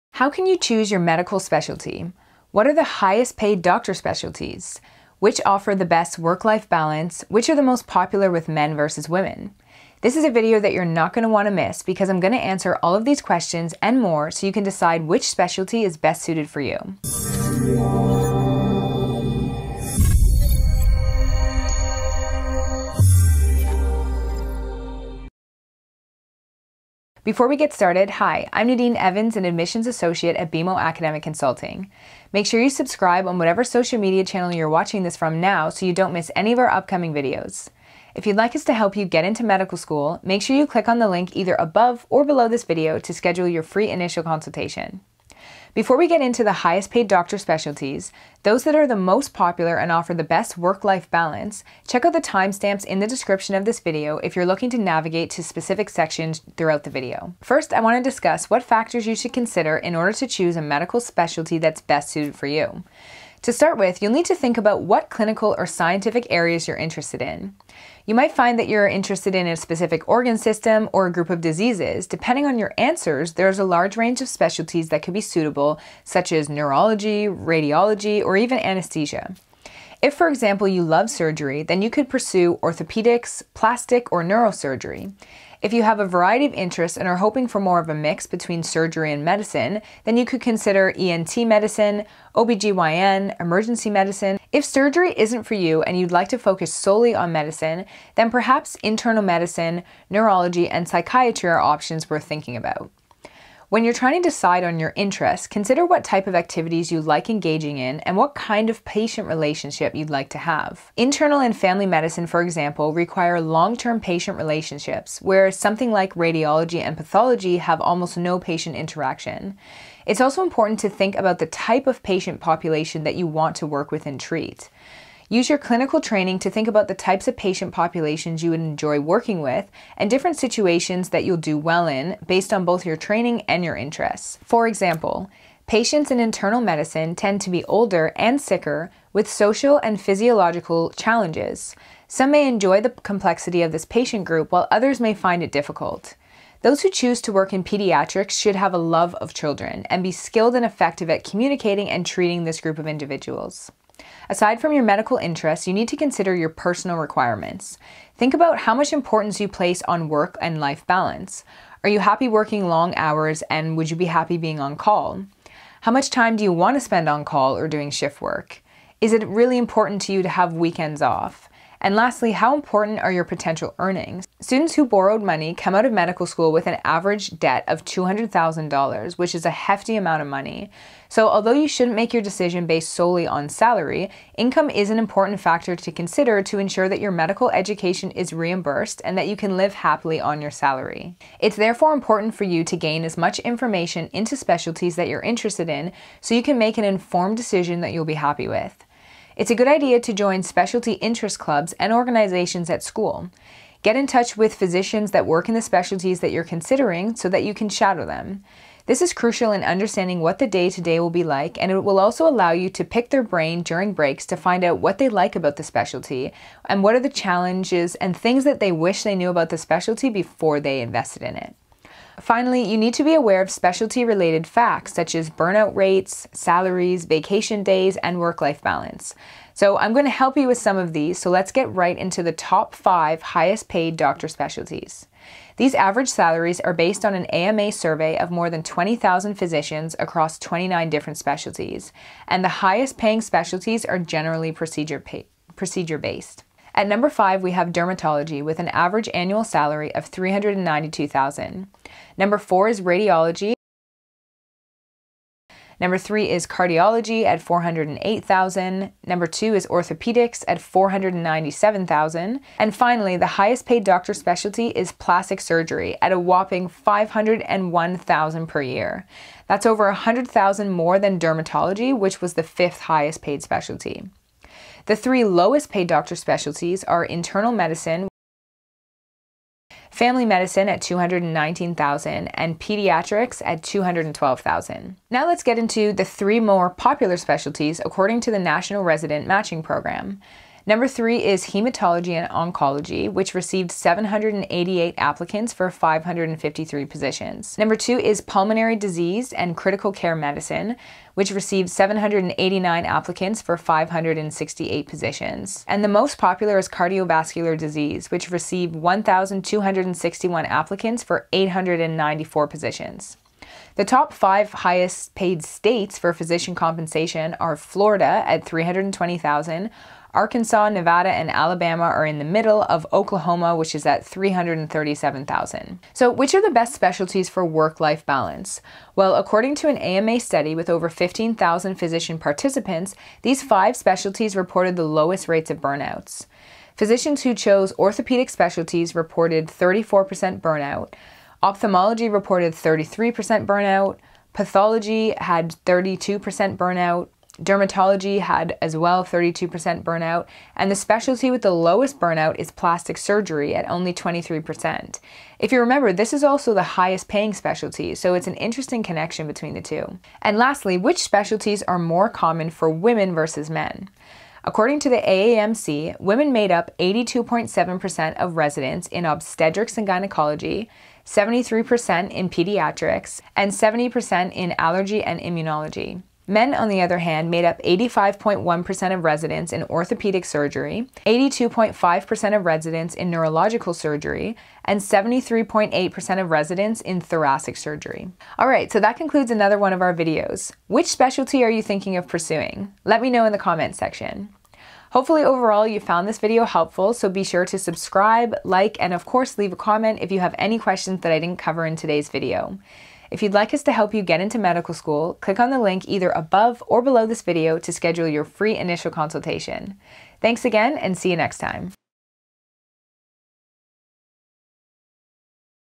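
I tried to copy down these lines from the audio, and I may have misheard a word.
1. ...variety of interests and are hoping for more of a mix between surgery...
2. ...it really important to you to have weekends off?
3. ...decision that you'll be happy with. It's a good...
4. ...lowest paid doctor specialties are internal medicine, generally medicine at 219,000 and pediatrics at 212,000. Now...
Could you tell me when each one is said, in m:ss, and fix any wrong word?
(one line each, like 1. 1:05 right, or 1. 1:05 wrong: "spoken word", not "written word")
1. 1:26 right
2. 2:49 right
3. 3:17 right
4. 4:35 wrong: "family", not "generally".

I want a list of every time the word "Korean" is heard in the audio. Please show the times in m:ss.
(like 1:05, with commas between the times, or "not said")
not said.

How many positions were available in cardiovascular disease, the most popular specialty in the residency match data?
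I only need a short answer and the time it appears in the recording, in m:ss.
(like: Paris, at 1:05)
894, at 5:11.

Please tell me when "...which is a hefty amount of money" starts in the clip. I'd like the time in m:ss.
2:59.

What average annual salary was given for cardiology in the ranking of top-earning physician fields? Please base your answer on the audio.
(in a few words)
$408,000.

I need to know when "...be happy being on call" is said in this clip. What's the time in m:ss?
2:43.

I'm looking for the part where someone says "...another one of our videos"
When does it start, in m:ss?
6:29.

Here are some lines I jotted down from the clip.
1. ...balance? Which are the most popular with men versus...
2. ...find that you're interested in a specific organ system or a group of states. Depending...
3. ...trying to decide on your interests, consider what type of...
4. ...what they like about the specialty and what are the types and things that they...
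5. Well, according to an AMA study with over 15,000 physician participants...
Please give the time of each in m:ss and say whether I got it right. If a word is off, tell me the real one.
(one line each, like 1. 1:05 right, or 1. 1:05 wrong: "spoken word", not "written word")
1. 0:06 right
2. 1:08 wrong: "diseases", not "states"
3. 1:43 right
4. 3:34 wrong: "challenges", not "types"
5. 5:28 right.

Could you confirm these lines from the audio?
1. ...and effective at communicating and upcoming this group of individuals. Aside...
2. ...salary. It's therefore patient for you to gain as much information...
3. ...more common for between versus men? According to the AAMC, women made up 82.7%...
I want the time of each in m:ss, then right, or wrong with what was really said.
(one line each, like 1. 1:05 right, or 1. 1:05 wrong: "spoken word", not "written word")
1. 2:30 wrong: "treating", not "upcoming"
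2. 3:10 wrong: "important", not "patient"
3. 6:01 wrong: "women", not "between".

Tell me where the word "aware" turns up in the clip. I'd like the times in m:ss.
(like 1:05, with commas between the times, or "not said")
3:43.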